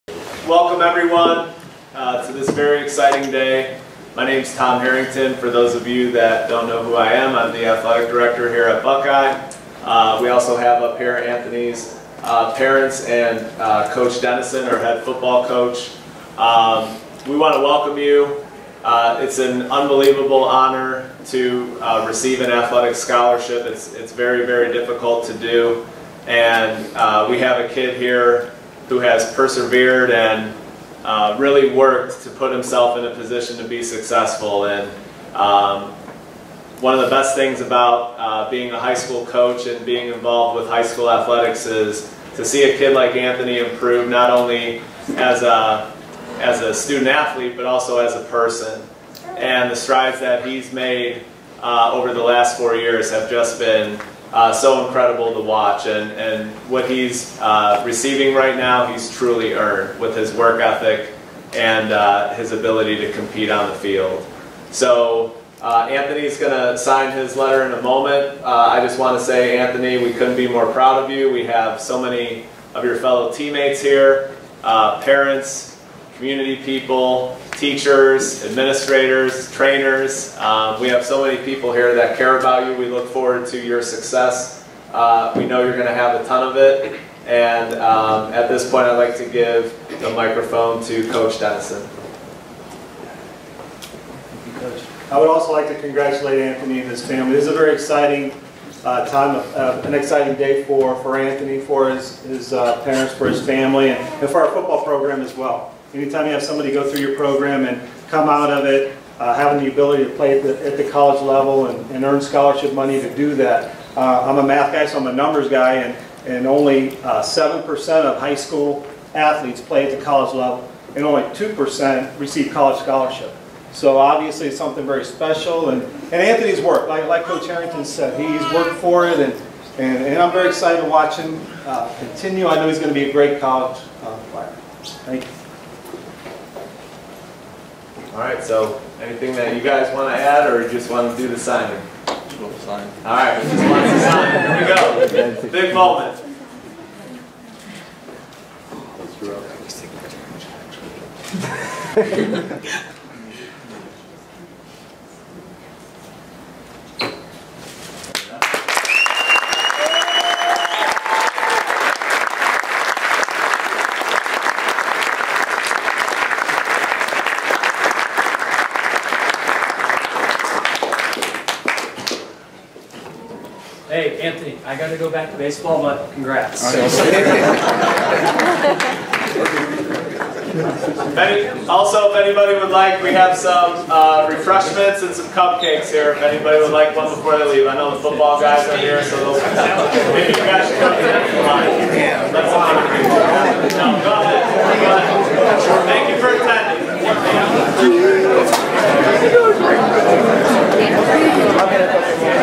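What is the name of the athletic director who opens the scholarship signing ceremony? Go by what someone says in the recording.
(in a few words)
Tom Harrington.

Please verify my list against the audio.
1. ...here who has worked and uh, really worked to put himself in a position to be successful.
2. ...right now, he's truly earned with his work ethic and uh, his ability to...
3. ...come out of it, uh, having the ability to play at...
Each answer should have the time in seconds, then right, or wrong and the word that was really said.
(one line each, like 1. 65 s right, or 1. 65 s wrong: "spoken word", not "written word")
1. 27 s wrong: "persevered", not "worked"
2. 58 s right
3. 108 s right.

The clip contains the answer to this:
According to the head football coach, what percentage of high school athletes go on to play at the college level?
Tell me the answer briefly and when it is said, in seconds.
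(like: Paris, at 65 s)
7%, at 116 s.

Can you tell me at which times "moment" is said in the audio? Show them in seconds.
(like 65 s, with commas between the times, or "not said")
67 s, 145 s.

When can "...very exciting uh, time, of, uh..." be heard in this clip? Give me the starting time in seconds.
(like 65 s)
97 s.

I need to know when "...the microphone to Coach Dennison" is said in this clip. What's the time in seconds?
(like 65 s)
89 s.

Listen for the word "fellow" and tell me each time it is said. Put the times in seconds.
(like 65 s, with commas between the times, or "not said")
72 s.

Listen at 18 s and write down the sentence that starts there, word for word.
Uh, it's an unbelievable honor to uh, receive an athletic scholarship.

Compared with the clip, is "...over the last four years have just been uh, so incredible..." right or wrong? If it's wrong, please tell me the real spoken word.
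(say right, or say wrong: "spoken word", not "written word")
right.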